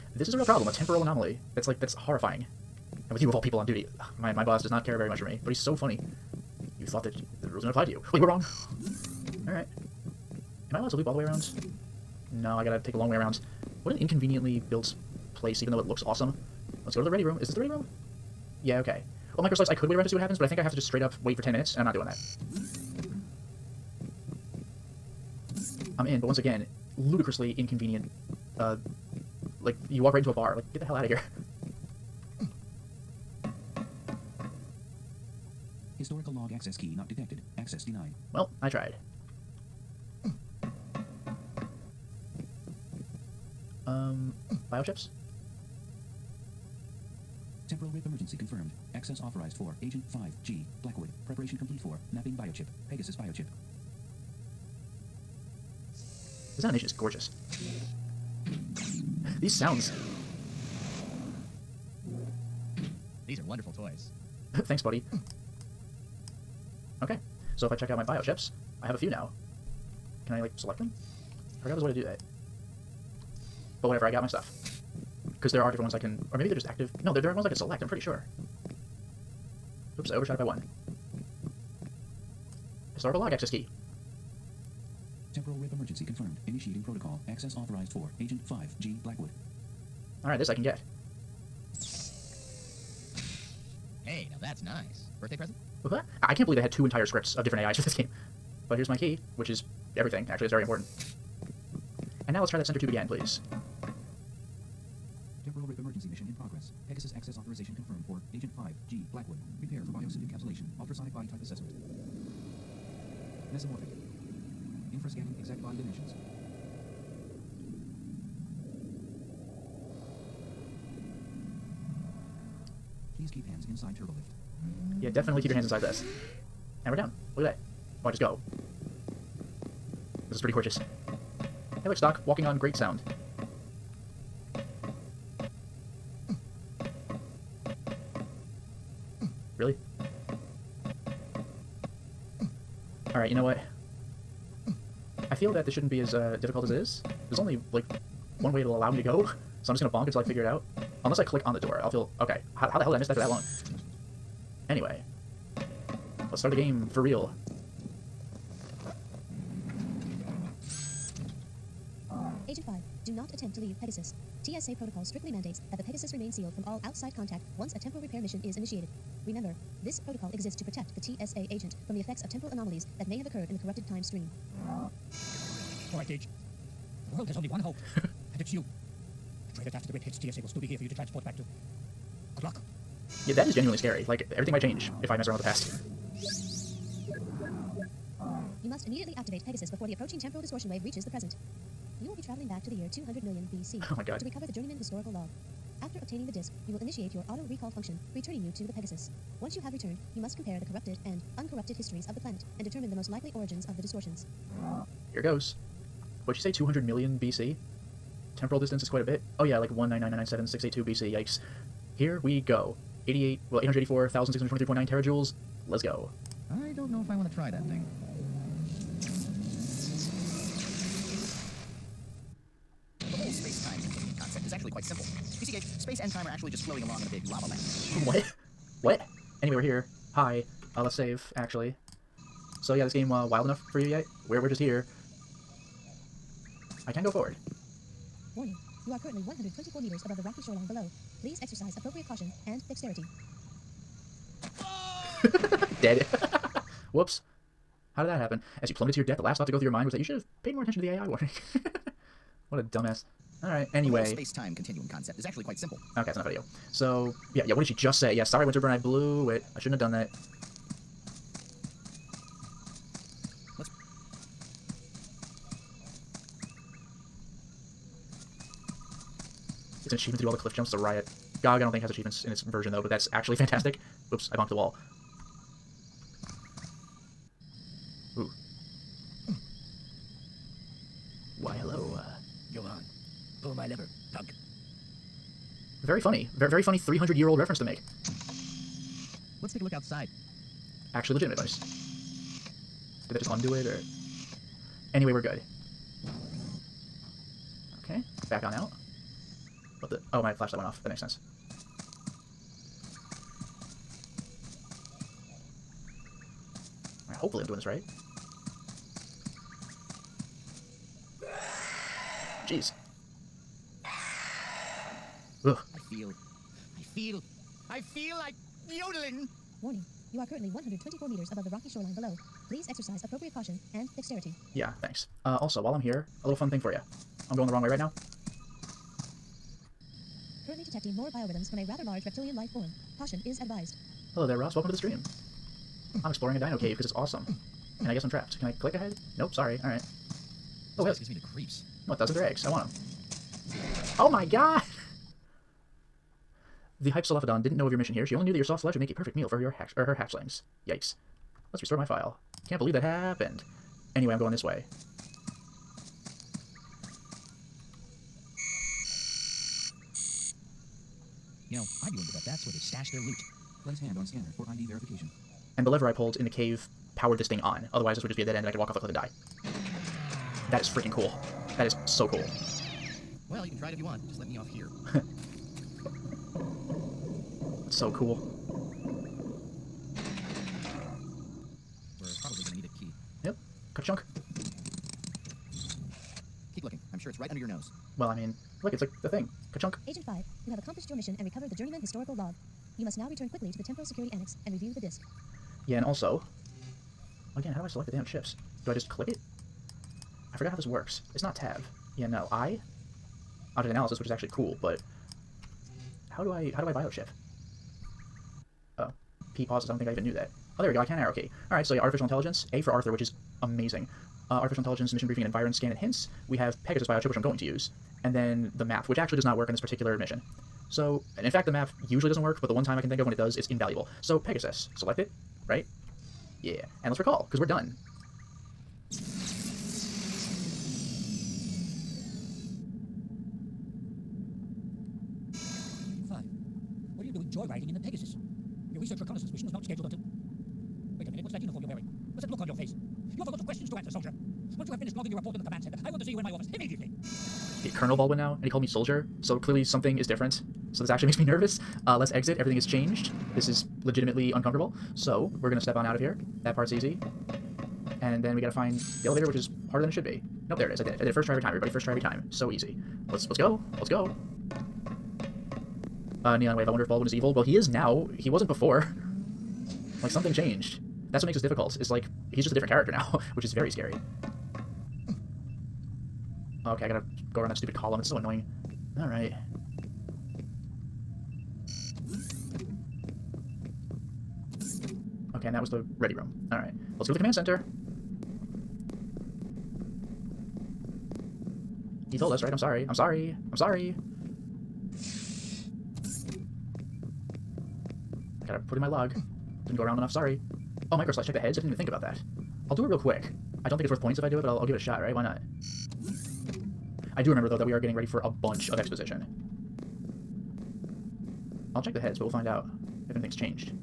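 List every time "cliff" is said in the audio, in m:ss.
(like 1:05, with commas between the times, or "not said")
4:30, 6:08.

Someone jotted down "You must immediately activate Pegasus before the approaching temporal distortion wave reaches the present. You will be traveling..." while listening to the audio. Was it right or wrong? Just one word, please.
right.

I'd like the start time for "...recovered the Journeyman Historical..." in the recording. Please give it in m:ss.
6:31.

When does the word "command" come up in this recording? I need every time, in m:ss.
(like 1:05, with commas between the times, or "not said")
7:25, 8:07.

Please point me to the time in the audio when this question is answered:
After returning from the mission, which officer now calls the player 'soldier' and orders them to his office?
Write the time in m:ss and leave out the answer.
7:27.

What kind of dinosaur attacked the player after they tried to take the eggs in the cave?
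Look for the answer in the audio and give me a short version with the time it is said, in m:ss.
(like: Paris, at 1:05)
Hypsilophodon, at 5:46.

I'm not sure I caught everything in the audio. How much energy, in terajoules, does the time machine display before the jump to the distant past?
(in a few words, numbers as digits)
884,623.9 terajoules.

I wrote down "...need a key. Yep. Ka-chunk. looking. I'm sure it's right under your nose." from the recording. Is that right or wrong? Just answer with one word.
right.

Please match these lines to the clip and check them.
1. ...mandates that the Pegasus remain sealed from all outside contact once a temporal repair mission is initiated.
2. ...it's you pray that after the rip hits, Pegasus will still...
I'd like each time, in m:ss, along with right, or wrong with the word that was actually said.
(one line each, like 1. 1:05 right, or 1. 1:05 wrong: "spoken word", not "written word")
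1. 2:45 right
2. 2:58 wrong: "TSA", not "Pegasus".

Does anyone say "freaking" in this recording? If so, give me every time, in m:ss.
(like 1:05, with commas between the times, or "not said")
6:10.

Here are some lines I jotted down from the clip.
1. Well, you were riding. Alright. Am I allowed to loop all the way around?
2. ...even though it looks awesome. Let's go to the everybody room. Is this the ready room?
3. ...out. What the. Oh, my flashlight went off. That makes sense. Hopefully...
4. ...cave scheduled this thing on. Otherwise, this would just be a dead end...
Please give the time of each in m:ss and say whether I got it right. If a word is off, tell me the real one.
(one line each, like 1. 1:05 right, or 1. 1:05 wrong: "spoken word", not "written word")
1. 0:08 wrong: "wrong", not "riding"
2. 0:15 wrong: "ready", not "everybody"
3. 4:58 right
4. 6:06 wrong: "powered", not "scheduled".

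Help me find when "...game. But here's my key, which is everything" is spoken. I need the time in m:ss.
1:37.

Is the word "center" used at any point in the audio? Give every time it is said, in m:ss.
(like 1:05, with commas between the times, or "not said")
1:42, 7:25, 8:07.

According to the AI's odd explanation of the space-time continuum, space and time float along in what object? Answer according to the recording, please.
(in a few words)
a big lava lamp.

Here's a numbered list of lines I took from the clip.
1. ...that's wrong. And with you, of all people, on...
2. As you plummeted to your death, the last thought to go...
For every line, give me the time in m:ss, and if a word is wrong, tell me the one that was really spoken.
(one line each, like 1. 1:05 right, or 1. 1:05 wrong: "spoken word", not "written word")
1. 0:01 wrong: "horrifying", not "wrong"
2. 4:08 right.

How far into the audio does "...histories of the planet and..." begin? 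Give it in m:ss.
3:21.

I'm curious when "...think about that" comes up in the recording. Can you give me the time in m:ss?
8:21.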